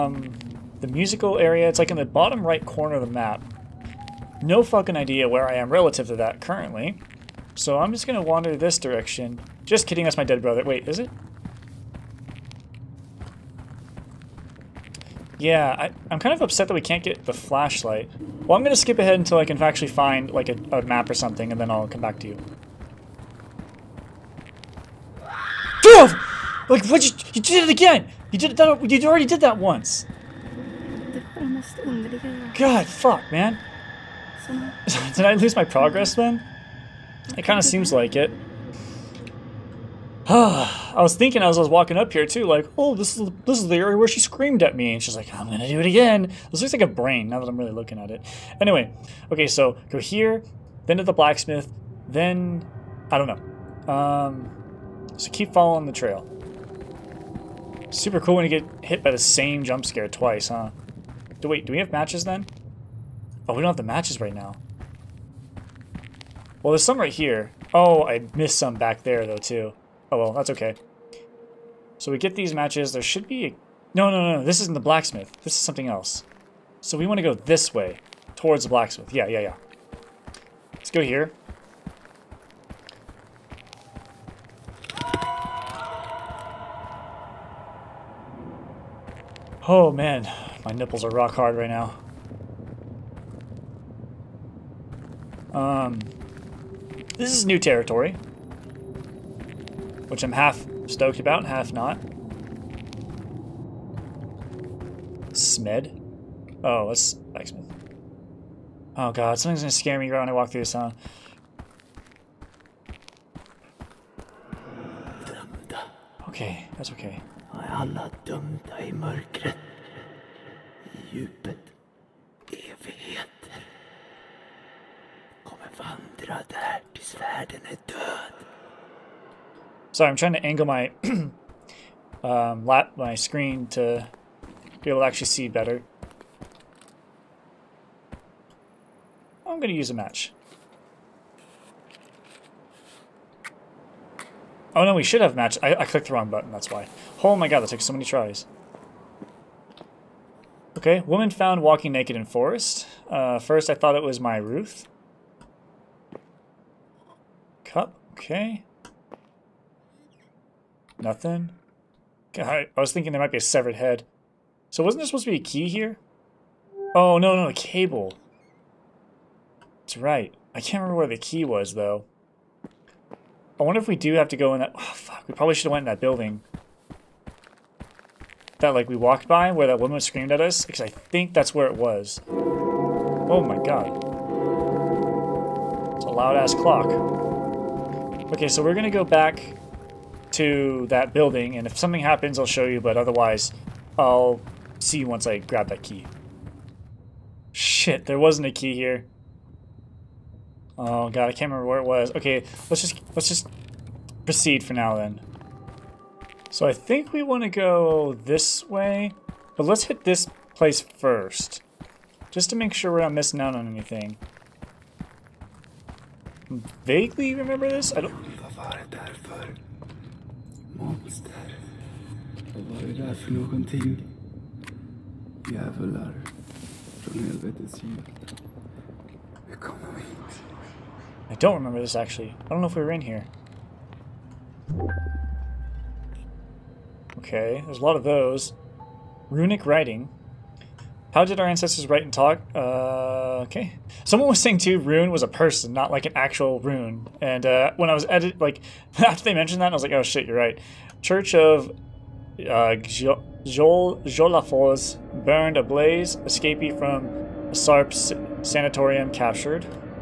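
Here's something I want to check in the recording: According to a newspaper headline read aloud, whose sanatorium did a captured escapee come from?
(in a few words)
Sarp's.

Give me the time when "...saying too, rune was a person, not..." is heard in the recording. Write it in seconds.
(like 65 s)
244 s.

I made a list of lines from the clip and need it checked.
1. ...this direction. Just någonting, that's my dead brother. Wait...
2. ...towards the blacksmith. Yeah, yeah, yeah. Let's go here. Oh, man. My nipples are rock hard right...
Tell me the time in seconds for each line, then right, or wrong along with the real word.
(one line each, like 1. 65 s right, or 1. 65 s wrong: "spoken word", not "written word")
1. 8 s wrong: "kidding", not "någonting"
2. 78 s right.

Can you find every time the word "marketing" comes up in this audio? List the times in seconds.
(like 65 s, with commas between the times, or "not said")
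not said.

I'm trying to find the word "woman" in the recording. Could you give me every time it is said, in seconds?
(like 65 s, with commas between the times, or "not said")
151 s, 179 s.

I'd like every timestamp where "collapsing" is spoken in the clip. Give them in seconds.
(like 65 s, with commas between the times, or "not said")
not said.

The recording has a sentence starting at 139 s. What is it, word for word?
I'm going to use a match.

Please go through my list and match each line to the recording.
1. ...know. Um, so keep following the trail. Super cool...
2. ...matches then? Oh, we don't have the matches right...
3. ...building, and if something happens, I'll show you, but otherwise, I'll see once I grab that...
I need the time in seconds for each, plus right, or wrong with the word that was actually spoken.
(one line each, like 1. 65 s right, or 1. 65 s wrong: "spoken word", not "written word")
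1. 53 s right
2. 61 s right
3. 191 s right.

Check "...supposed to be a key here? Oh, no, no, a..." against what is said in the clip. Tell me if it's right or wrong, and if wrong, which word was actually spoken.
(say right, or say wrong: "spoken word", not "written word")
right.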